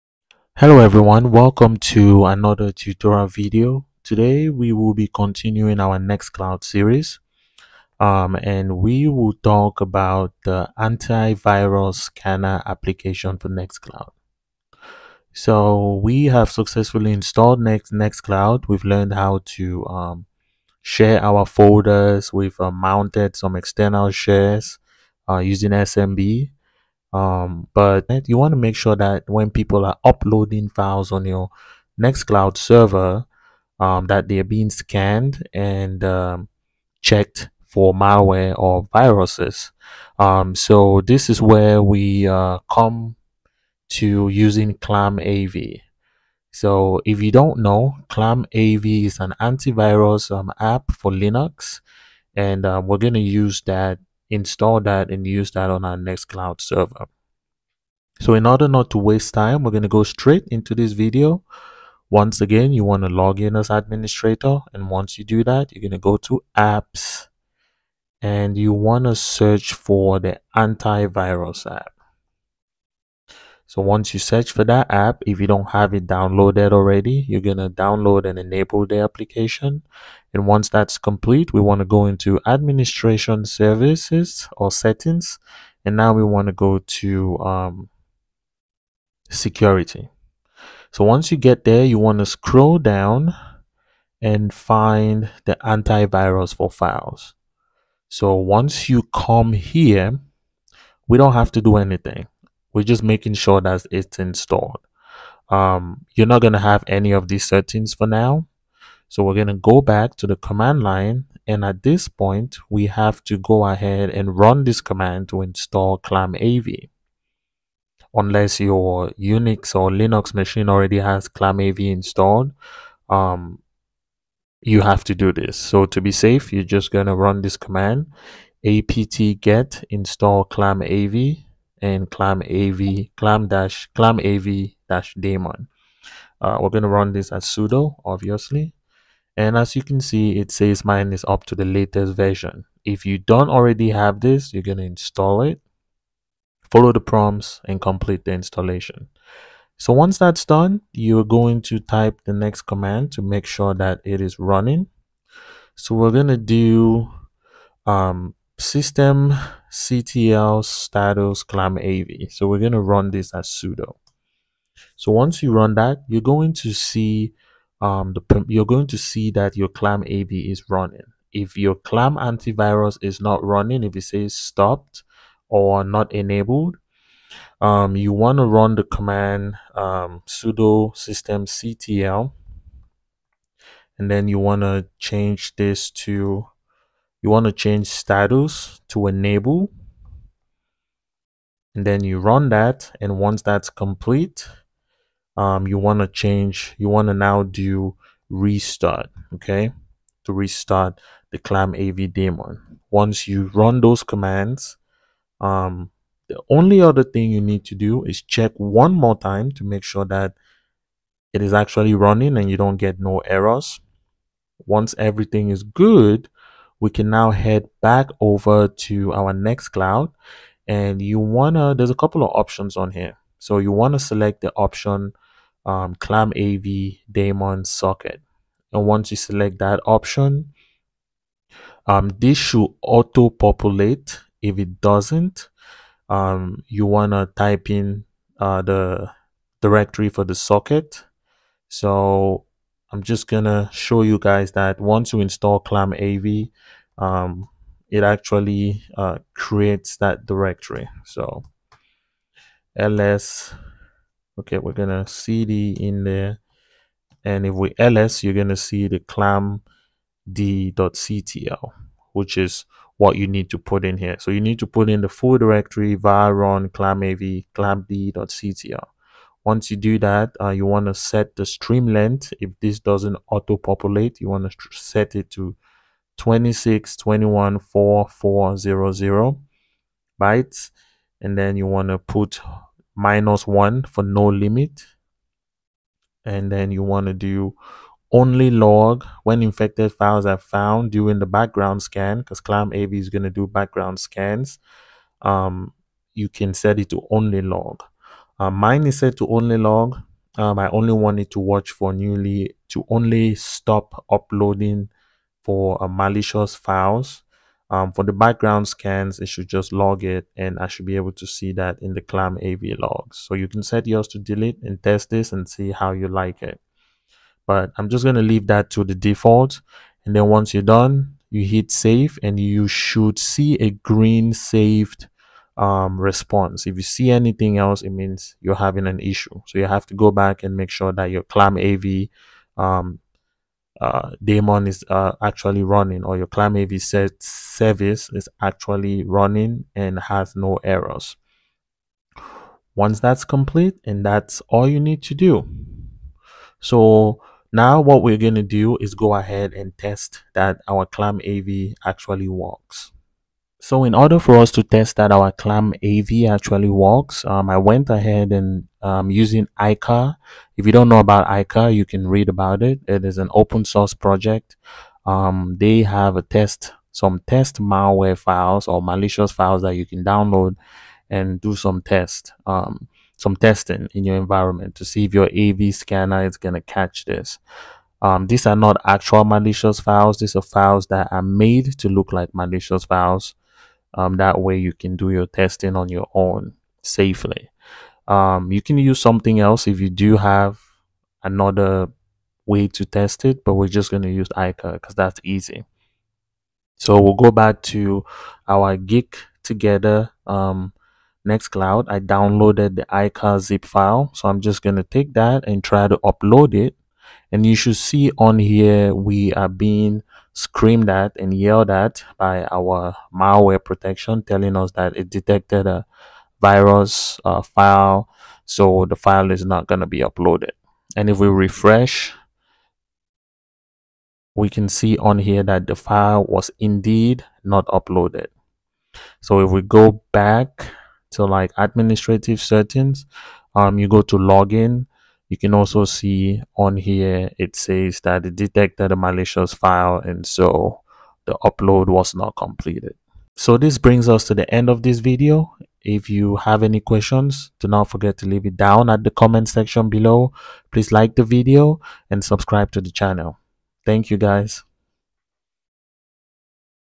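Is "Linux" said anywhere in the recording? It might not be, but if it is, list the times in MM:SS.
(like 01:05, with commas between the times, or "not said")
00:51, 01:59.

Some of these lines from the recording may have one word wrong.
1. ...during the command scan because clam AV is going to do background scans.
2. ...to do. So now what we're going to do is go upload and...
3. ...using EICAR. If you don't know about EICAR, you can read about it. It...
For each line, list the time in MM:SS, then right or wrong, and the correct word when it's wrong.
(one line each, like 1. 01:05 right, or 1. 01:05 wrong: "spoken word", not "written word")
1. 04:50 wrong: "background", not "command"
2. 05:45 wrong: "ahead", not "upload"
3. 05:59 right.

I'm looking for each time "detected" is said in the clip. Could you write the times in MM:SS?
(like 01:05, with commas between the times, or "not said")
06:55, 07:18.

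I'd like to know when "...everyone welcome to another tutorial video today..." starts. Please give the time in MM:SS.
00:00.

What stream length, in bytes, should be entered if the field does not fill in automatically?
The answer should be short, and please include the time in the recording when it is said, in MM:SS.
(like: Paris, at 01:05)
26214400, at 04:36.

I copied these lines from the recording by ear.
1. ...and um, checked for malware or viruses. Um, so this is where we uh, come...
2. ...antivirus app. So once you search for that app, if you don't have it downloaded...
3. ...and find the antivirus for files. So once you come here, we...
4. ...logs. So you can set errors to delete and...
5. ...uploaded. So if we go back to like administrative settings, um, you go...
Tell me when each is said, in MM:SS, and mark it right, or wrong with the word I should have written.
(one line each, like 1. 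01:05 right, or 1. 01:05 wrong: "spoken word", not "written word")
1. 00:35 right
2. 01:10 right
3. 01:34 right
4. 05:12 wrong: "yours", not "errors"
5. 07:07 right.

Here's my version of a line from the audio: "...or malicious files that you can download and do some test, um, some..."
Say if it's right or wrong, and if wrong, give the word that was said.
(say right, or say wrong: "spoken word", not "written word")
right.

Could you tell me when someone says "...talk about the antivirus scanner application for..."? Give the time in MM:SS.
00:09.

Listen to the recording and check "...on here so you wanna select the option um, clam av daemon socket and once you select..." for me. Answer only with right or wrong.
right.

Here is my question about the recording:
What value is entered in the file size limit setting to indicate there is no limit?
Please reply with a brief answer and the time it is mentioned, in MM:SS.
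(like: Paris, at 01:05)
-1, at 04:42.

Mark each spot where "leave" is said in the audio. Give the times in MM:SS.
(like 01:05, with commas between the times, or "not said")
05:18, 07:28.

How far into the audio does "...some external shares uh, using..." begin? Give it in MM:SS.
00:23.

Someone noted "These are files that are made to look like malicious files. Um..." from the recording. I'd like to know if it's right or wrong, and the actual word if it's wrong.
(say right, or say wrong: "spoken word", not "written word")
right.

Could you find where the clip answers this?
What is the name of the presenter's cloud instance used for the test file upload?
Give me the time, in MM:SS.
06:38.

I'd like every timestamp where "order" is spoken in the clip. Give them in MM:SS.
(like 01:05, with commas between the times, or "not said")
00:58, 05:53.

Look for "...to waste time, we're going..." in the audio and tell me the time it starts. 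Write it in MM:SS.
00:58.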